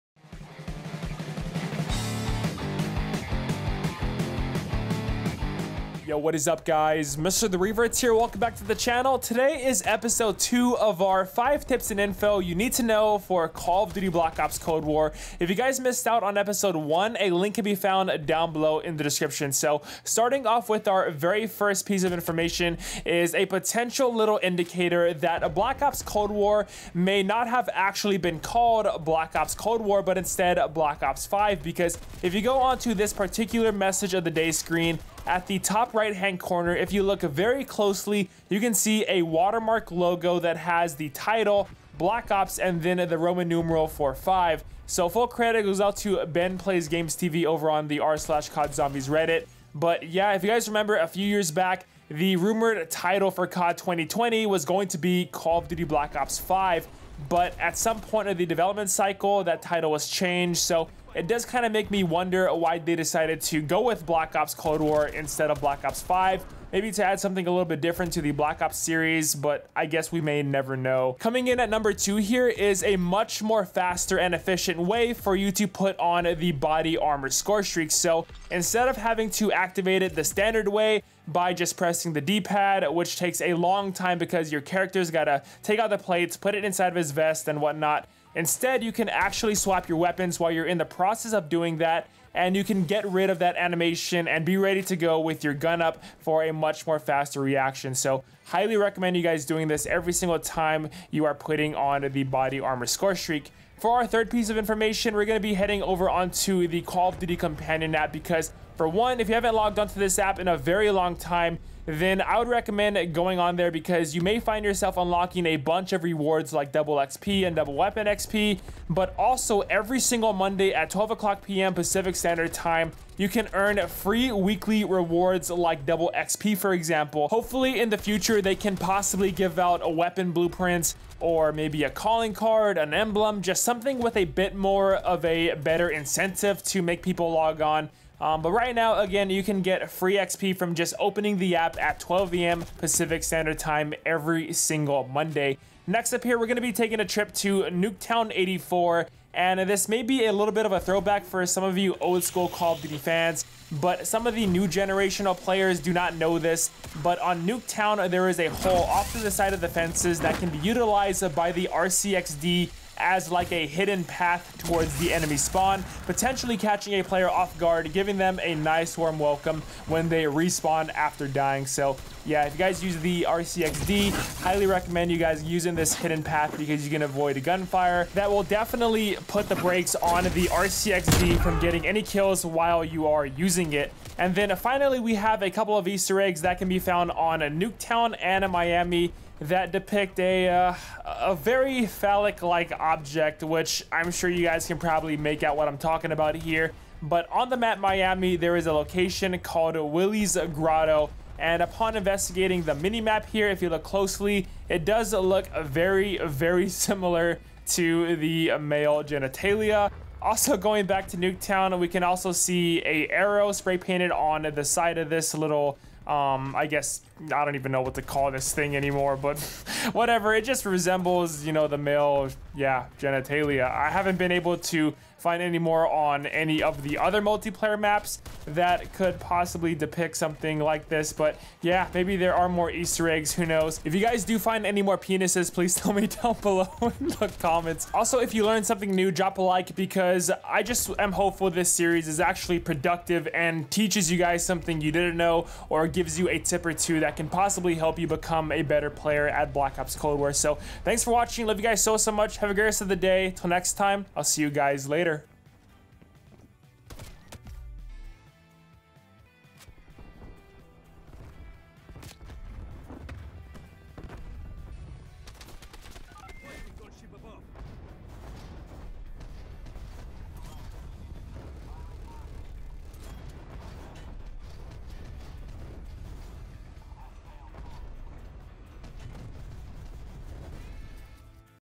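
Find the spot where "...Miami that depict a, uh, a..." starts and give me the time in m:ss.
3:08.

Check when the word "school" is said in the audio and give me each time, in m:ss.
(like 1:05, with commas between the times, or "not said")
2:32.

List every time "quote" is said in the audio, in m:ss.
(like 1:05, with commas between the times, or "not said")
not said.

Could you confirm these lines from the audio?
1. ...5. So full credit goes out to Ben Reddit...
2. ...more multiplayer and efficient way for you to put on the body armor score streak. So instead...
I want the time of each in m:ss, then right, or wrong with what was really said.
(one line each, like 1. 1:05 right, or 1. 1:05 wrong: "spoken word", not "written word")
1. 0:44 wrong: "Plays", not "Reddit"
2. 1:13 wrong: "faster", not "multiplayer".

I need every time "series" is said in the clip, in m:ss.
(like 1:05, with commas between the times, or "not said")
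1:08, 4:01.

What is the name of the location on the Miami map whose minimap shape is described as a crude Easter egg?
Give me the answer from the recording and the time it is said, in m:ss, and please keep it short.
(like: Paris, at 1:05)
Willie's Grotto, at 3:19.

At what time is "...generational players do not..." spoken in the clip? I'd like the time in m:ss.
2:34.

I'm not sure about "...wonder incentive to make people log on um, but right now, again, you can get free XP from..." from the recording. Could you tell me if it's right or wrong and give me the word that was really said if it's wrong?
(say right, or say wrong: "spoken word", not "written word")
wrong: "better", not "wonder".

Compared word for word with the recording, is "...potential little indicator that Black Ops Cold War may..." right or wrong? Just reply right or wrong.
right.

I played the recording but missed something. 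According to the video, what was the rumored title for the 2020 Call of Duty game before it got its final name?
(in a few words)
Call of Duty Black Ops 5.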